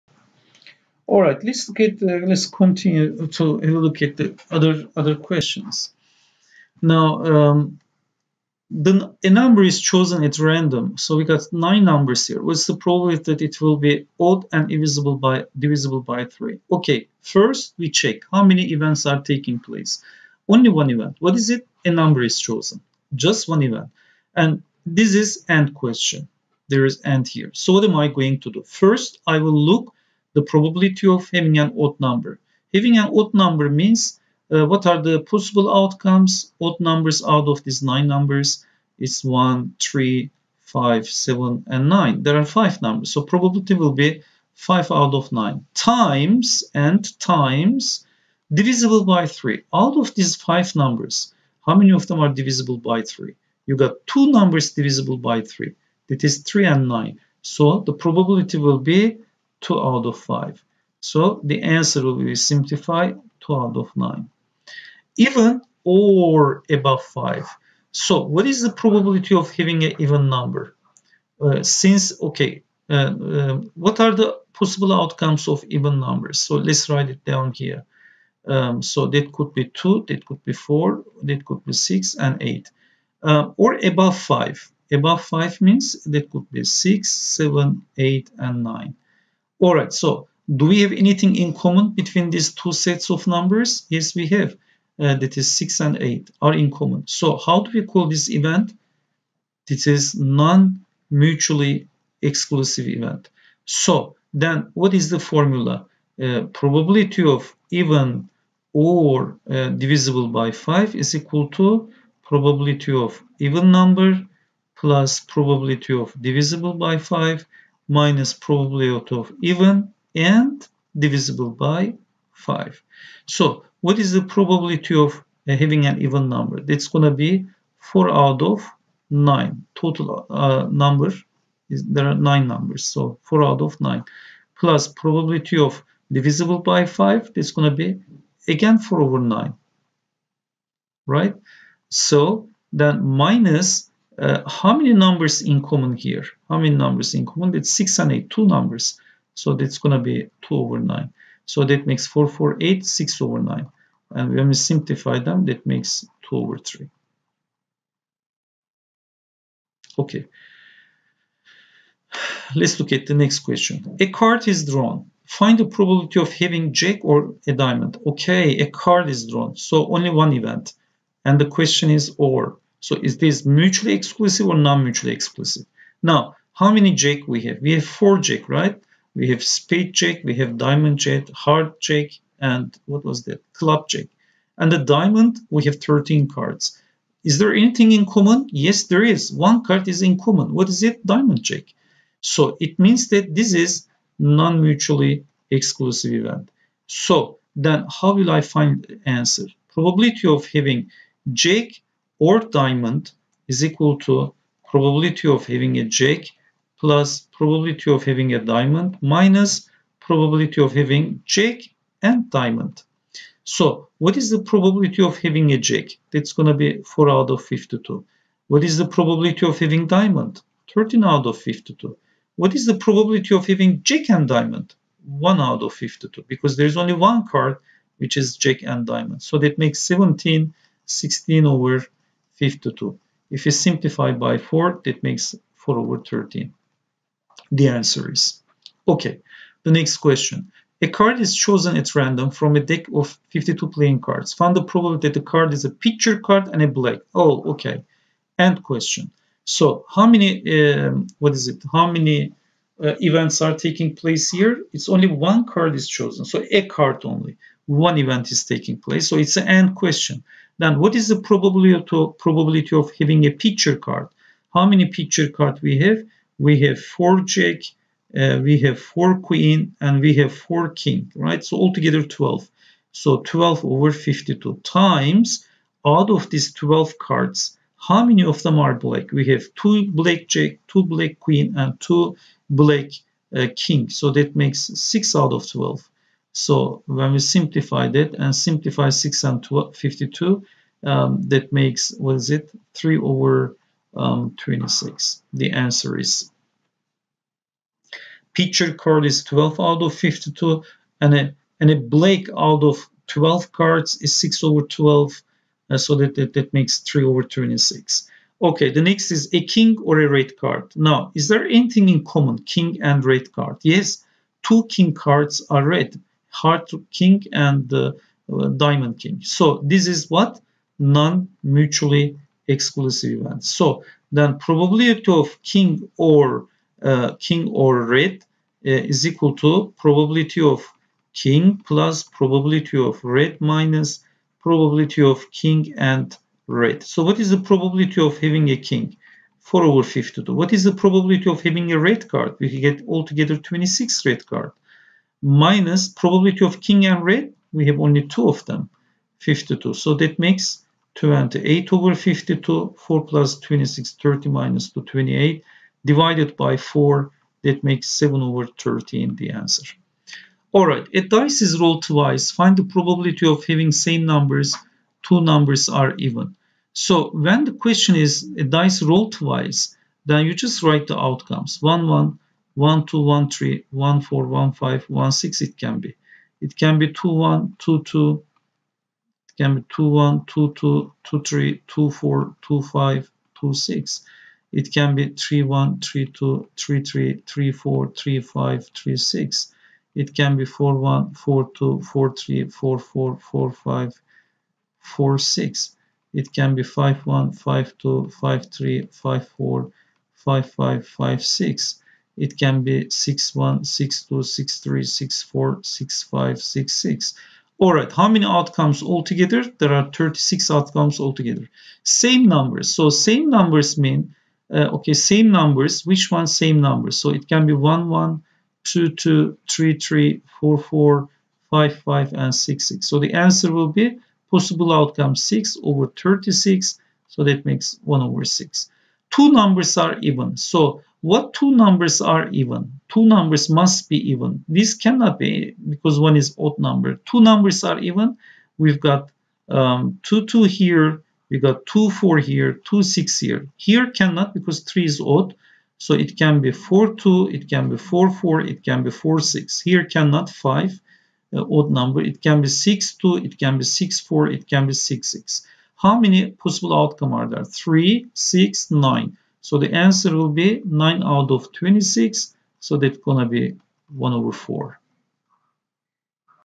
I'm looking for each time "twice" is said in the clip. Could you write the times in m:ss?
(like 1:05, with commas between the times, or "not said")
6:01, 6:09.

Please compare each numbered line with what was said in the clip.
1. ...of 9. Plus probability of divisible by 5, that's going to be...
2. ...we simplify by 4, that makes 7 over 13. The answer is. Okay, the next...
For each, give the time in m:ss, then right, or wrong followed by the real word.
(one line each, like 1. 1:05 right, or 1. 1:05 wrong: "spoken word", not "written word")
1. 2:13 right
2. 3:53 wrong: "4", not "7".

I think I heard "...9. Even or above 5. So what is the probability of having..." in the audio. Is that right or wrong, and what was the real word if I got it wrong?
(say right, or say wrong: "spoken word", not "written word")
right.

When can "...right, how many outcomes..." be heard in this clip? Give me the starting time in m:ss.
6:47.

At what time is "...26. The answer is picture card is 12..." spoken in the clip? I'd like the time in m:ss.
4:54.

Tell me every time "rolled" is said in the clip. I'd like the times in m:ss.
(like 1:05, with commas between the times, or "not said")
6:01, 6:08.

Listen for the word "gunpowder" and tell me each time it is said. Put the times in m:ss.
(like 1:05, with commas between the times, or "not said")
not said.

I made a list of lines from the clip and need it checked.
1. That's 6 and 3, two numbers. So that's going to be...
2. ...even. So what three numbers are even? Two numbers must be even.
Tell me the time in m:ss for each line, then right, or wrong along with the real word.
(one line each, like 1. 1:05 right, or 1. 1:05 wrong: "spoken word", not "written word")
1. 2:27 wrong: "8", not "3"
2. 7:09 wrong: "two", not "three".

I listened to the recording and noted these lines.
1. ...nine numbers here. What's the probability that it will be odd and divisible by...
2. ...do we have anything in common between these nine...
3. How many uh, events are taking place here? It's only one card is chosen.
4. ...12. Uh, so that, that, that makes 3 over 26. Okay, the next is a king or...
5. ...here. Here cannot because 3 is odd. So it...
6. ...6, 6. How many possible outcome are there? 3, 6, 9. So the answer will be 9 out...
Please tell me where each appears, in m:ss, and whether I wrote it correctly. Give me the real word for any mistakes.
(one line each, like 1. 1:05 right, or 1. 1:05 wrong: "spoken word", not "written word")
1. 0:11 right
2. 1:30 wrong: "two", not "nine"
3. 4:11 right
4. 5:04 right
5. 7:23 right
6. 7:34 right.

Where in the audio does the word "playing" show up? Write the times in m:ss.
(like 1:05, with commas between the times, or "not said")
4:03.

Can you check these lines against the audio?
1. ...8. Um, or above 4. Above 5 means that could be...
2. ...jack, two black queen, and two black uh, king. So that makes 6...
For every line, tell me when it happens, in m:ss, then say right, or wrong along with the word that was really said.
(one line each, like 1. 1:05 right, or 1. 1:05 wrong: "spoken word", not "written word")
1. 1:22 wrong: "5", not "4"
2. 4:40 right.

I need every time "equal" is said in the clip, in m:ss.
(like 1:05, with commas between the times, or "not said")
1:51, 3:23, 5:29.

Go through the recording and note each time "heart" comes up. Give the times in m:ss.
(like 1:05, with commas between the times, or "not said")
3:01, 5:16.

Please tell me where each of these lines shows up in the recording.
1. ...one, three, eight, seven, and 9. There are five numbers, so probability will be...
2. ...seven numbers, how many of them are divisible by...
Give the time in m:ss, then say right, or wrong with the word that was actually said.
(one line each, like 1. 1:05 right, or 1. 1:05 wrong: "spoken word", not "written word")
1. 0:39 wrong: "five", not "eight"
2. 0:50 wrong: "five", not "seven".